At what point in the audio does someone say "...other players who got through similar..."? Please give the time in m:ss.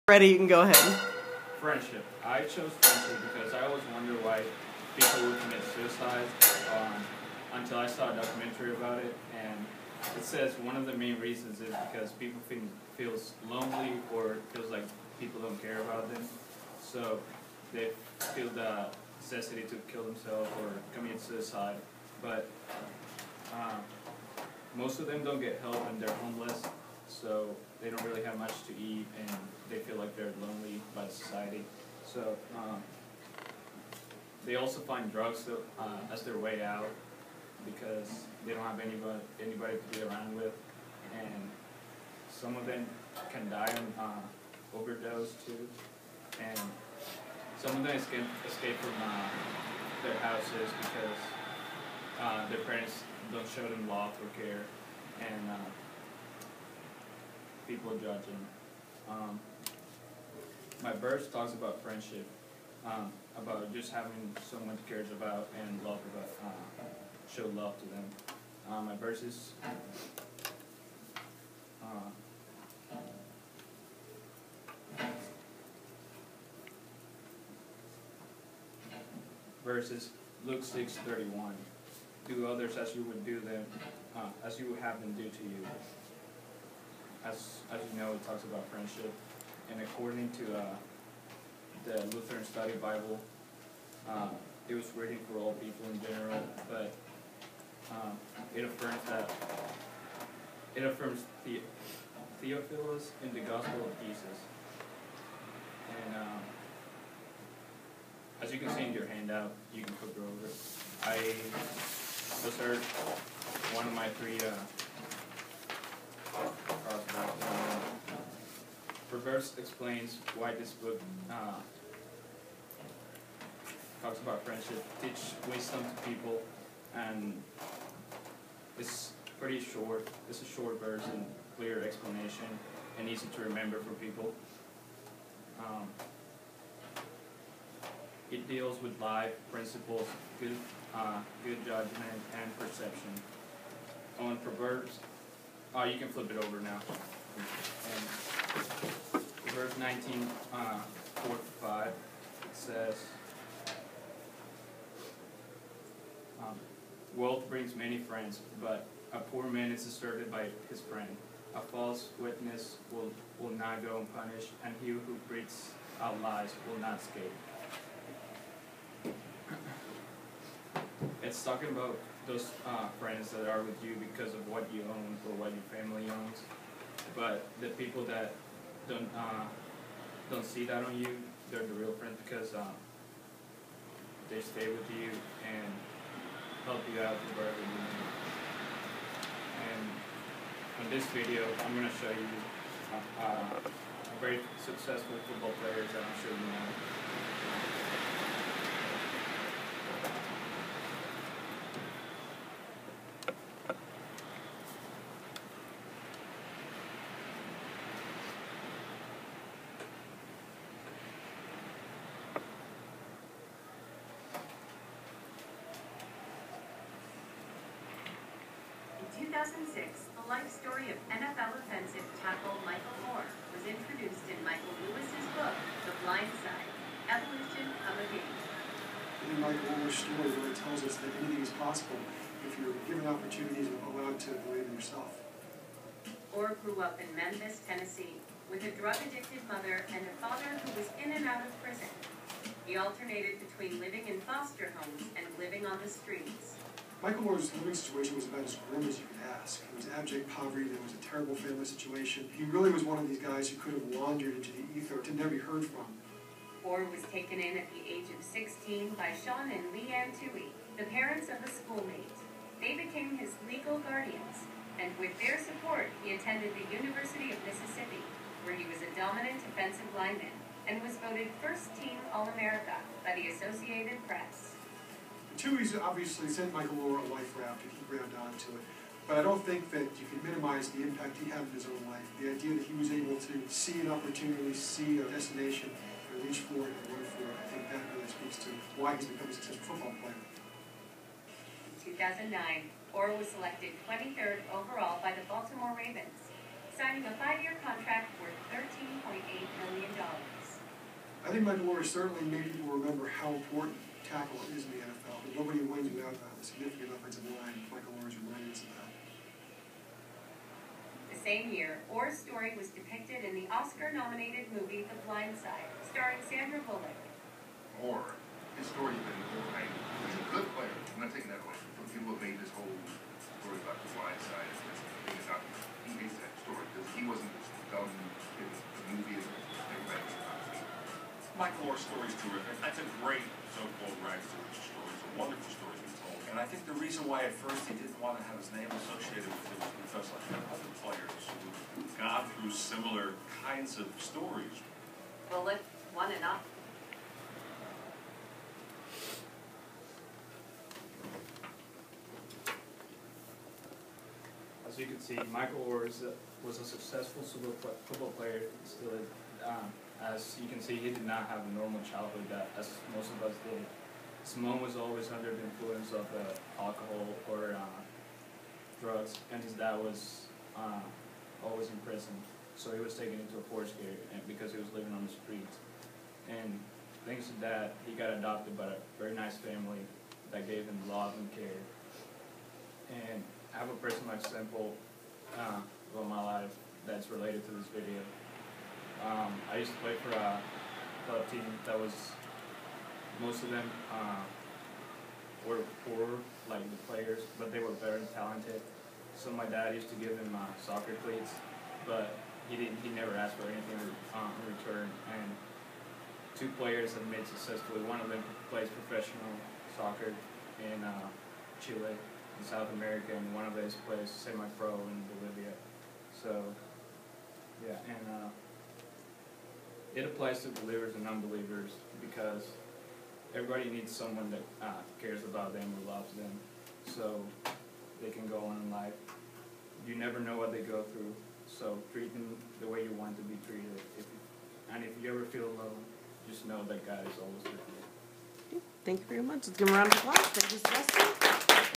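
5:40.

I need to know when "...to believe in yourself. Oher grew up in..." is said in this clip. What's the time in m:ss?
3:54.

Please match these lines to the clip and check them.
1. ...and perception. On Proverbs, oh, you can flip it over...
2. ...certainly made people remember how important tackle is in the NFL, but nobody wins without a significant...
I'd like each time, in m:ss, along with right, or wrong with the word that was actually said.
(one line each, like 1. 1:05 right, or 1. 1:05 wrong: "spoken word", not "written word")
1. 2:22 right
2. 5:01 right.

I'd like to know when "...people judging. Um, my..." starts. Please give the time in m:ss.
0:57.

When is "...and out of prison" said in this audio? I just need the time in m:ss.
4:01.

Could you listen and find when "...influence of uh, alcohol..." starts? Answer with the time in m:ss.
6:05.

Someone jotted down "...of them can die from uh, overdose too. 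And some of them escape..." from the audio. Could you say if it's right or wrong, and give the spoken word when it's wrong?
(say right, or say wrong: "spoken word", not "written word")
right.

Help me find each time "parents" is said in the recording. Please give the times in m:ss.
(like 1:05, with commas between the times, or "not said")
0:52, 4:20.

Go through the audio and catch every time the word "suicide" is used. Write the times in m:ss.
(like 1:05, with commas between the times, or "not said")
0:05, 0:21.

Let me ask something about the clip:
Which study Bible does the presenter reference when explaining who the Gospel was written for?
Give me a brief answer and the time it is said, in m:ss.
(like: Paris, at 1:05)
Lutheran Study Bible, at 1:32.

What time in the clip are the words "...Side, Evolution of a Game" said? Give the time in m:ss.
3:46.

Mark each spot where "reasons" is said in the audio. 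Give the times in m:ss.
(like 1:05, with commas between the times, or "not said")
0:11, 5:36.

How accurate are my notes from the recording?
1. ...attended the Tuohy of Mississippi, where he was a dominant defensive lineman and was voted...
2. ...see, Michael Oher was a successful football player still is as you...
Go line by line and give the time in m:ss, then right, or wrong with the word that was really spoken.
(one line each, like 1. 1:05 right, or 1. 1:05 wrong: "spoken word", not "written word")
1. 4:26 wrong: "University", not "Tuohy"
2. 5:55 right.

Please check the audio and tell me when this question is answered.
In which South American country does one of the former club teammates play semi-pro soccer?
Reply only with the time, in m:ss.
6:55.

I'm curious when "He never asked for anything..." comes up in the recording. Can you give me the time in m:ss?
6:42.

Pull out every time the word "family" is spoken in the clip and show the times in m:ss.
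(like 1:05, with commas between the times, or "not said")
2:55, 4:11, 6:19.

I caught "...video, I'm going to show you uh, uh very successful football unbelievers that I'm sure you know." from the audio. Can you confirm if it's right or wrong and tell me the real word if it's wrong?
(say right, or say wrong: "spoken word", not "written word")
wrong: "players", not "unbelievers".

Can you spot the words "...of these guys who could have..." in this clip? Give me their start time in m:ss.
4:12.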